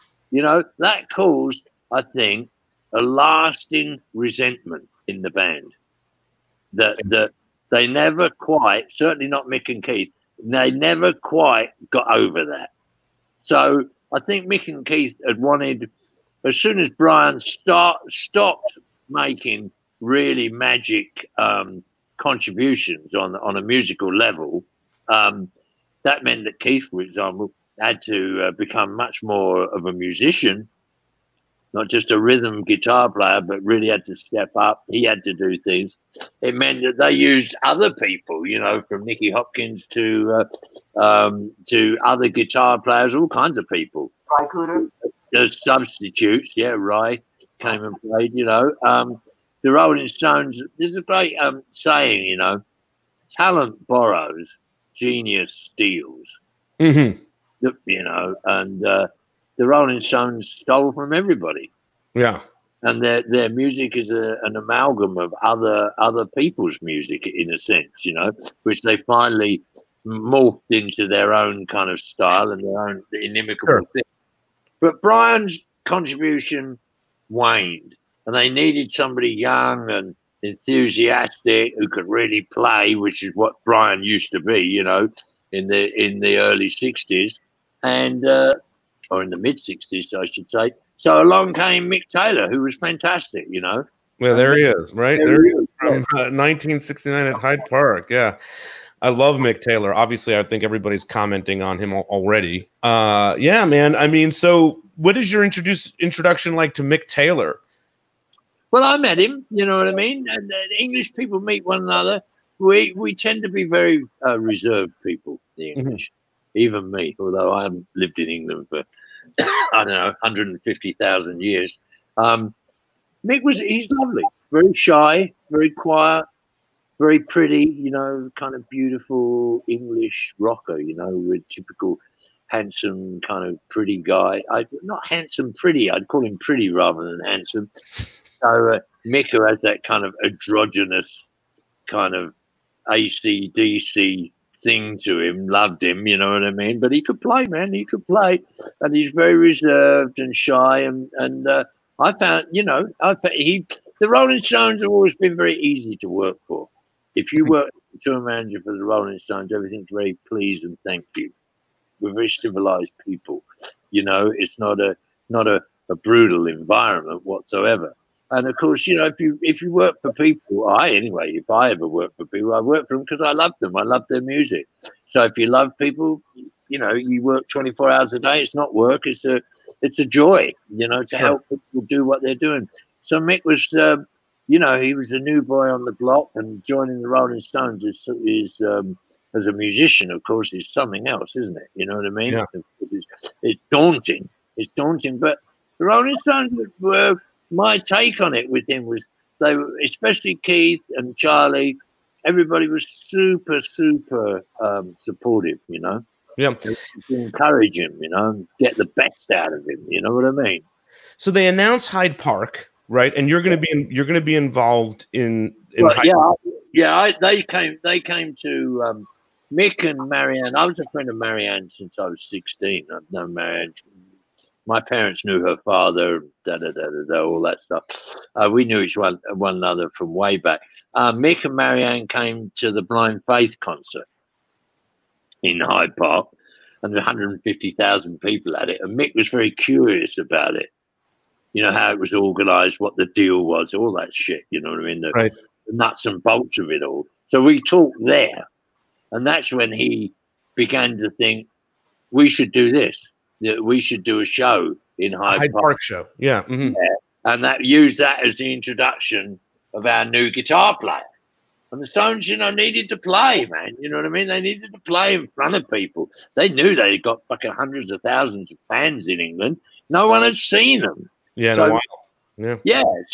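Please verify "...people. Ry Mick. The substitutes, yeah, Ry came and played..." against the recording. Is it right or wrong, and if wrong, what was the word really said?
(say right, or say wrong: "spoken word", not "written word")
wrong: "Cooder", not "Mick".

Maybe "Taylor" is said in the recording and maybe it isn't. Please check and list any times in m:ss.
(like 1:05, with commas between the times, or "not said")
1:32, 1:39, 1:47.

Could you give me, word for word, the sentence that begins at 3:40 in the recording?
I was a friend of Marianne since I was 16.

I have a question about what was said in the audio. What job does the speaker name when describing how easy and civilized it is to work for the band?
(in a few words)
Tour manager.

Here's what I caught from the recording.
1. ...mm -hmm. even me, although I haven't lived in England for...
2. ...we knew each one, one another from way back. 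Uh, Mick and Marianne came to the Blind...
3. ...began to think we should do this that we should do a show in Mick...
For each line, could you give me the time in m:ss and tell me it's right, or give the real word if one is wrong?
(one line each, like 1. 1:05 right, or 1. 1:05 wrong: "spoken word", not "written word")
1. 1:56 right
2. 3:48 right
3. 4:10 wrong: "Hyde", not "Mick".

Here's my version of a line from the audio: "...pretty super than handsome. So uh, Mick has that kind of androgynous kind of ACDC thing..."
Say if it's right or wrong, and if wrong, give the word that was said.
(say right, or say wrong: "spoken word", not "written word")
wrong: "rather", not "super".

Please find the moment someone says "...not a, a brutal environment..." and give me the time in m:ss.
2:45.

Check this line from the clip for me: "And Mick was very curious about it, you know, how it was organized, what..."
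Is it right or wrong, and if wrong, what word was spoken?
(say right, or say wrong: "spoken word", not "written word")
right.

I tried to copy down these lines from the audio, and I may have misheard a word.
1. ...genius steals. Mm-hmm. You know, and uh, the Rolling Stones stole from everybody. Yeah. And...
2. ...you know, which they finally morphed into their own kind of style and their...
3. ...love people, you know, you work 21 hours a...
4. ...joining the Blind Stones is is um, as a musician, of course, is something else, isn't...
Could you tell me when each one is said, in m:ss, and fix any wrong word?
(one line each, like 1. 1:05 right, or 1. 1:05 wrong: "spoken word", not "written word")
1. 0:54 right
2. 1:08 right
3. 2:55 wrong: "24", not "21"
4. 3:06 wrong: "Rolling", not "Blind".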